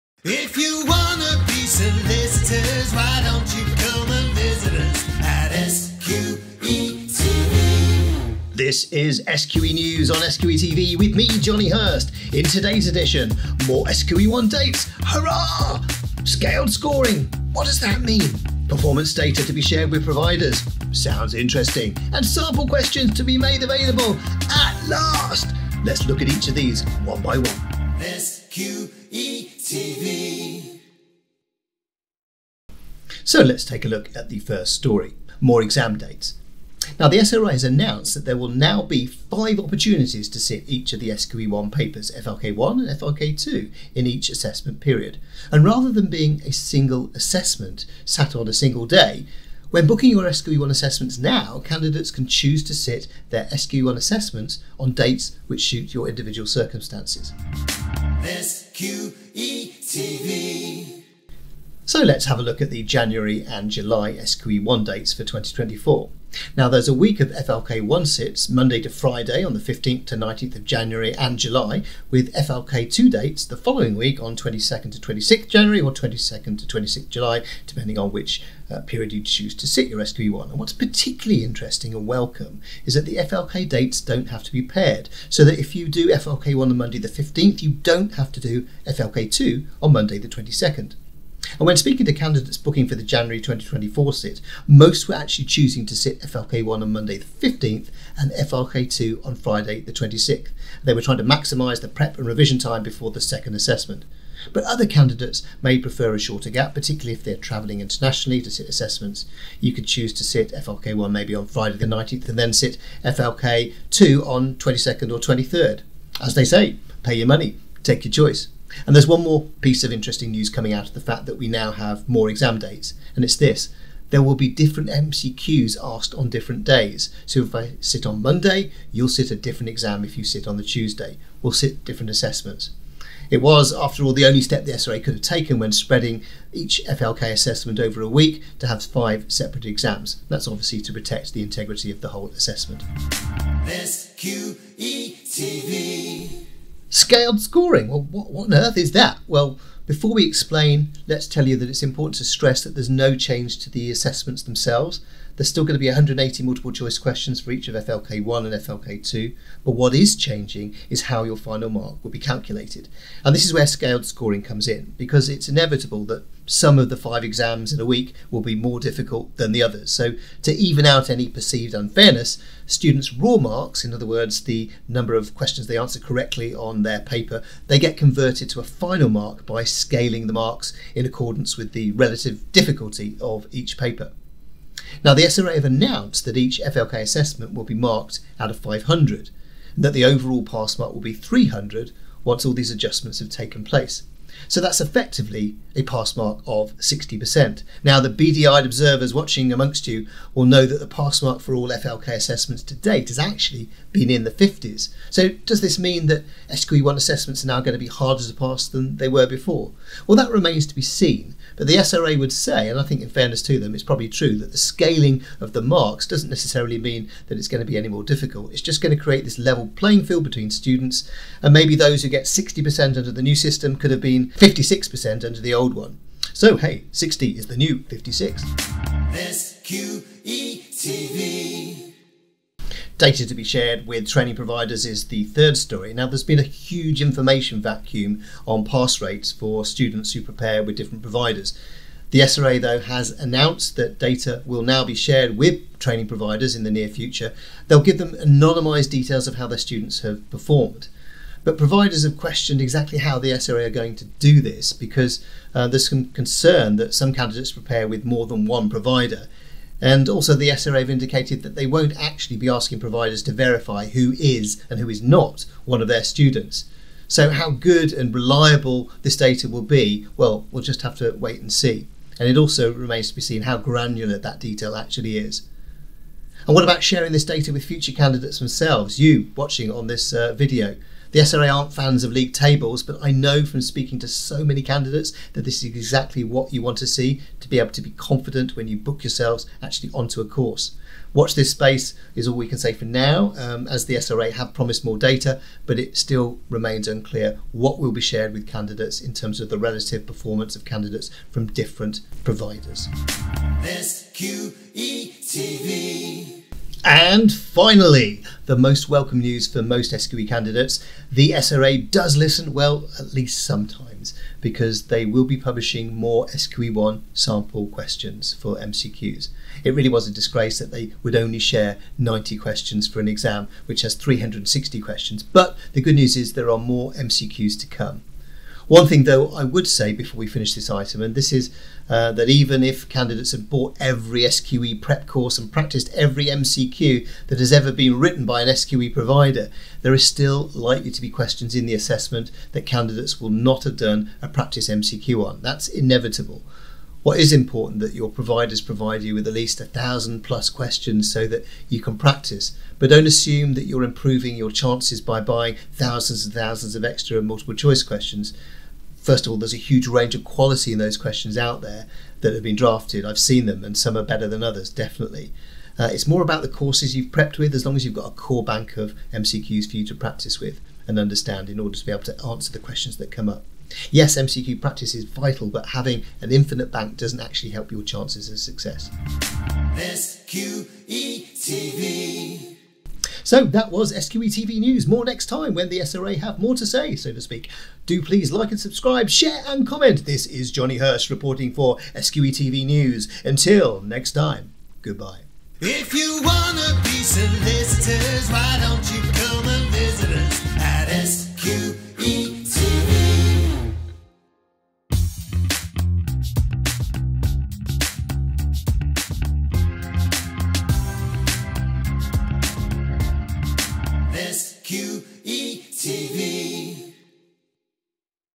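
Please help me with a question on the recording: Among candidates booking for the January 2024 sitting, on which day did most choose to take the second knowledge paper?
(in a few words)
Friday the 26th.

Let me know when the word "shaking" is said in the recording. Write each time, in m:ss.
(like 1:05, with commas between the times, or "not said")
not said.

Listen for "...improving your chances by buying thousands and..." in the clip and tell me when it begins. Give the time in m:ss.
5:53.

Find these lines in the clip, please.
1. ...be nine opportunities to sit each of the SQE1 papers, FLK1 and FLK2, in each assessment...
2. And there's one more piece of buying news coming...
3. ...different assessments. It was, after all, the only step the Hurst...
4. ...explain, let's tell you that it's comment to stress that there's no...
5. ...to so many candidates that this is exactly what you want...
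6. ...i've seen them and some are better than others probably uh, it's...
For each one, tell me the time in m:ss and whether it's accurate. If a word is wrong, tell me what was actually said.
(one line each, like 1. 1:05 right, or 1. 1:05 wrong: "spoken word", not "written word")
1. 0:38 wrong: "five", not "nine"
2. 1:58 wrong: "interesting", not "buying"
3. 2:11 wrong: "SRA", not "Hurst"
4. 2:30 wrong: "important", not "comment"
5. 4:43 right
6. 6:03 wrong: "definitely", not "probably".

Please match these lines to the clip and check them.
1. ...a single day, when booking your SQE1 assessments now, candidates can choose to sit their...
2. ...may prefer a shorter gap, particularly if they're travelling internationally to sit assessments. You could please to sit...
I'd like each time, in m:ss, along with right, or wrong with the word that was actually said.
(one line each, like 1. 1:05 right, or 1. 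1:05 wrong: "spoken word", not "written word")
1. 0:48 right
2. 1:45 wrong: "choose", not "please".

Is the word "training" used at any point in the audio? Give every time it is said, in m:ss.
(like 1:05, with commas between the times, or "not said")
3:54, 4:05.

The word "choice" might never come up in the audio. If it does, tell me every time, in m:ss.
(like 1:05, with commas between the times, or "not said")
1:58, 2:36, 5:57.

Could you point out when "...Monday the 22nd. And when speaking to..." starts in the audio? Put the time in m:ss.
1:29.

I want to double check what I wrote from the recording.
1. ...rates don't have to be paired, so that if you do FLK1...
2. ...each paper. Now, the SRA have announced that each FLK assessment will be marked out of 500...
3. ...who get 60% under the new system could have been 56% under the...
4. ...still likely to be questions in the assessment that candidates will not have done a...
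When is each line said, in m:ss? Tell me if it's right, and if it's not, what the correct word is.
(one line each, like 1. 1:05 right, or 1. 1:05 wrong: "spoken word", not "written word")
1. 1:23 wrong: "dates", not "rates"
2. 3:03 right
3. 3:42 right
4. 5:40 right.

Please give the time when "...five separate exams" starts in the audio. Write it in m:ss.
2:18.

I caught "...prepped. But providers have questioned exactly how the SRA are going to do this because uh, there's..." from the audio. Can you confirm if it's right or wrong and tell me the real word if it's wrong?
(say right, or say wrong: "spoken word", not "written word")
wrong: "performed", not "prepped".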